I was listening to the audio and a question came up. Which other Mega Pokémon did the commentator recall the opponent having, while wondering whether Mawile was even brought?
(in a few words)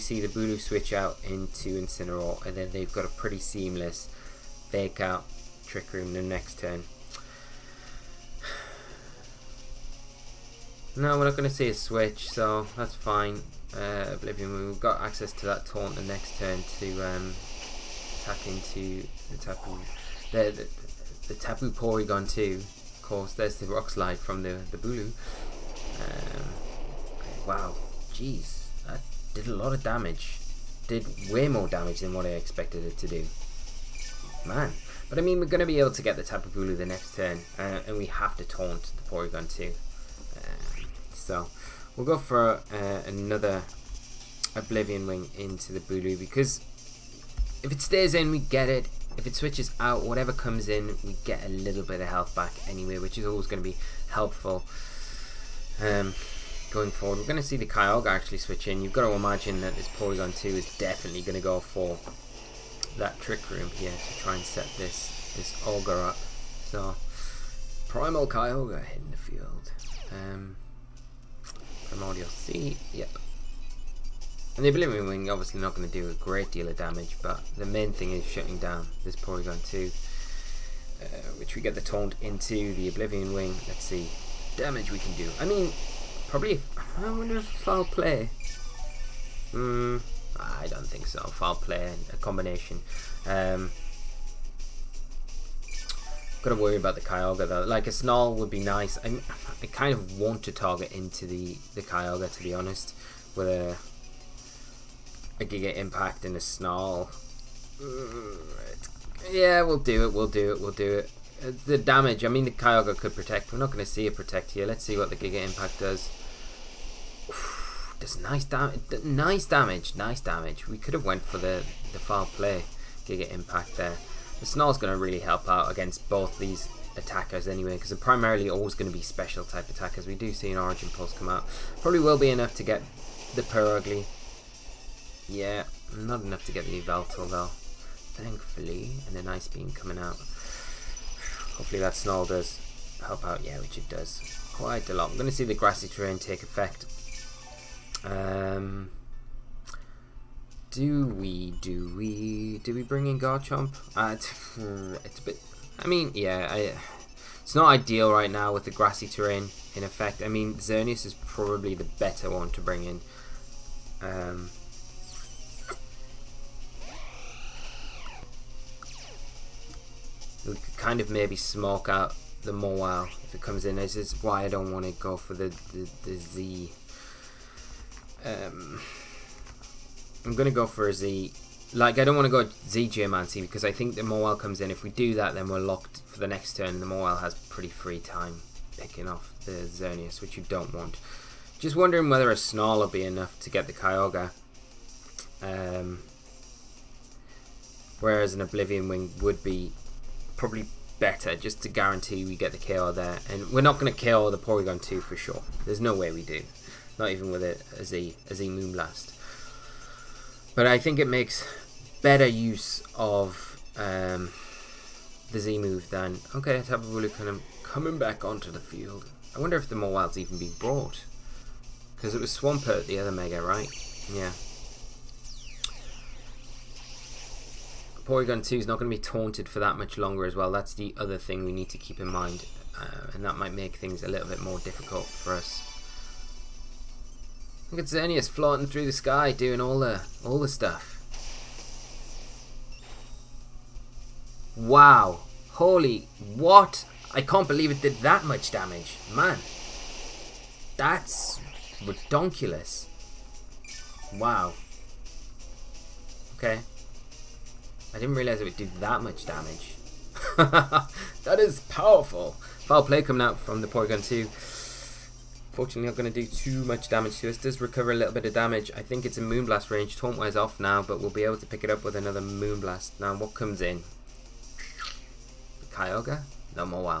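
Swampert.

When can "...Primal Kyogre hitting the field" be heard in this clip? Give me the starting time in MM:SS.
01:07.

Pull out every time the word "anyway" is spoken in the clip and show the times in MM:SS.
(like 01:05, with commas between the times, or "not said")
00:52, 02:07.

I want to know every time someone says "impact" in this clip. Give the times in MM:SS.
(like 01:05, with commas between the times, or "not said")
01:45, 01:55, 02:03.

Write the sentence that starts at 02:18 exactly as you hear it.
Thankfully, and an Ice Beam coming out.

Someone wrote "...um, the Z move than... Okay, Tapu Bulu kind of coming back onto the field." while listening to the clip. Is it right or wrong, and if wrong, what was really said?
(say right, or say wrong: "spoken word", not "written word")
right.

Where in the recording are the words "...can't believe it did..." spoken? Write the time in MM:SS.
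04:07.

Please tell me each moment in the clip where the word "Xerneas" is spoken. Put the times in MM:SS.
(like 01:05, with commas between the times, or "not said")
02:40, 03:09, 03:57.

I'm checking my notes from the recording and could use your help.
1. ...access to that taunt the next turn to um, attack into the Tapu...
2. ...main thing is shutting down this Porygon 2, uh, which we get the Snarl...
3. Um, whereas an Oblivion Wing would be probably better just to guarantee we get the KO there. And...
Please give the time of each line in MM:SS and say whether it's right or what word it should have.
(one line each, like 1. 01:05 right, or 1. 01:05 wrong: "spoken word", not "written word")
1. 00:15 right
2. 01:17 wrong: "Taunt", not "Snarl"
3. 03:15 right.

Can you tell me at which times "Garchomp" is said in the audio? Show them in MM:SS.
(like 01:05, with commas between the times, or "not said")
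02:33.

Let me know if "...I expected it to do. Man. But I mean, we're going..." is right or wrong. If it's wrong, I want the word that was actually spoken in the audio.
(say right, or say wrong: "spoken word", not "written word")
right.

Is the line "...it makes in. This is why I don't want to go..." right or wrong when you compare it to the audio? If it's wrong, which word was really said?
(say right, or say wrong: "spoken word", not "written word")
wrong: "comes", not "makes".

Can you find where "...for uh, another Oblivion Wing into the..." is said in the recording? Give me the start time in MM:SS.
00:42.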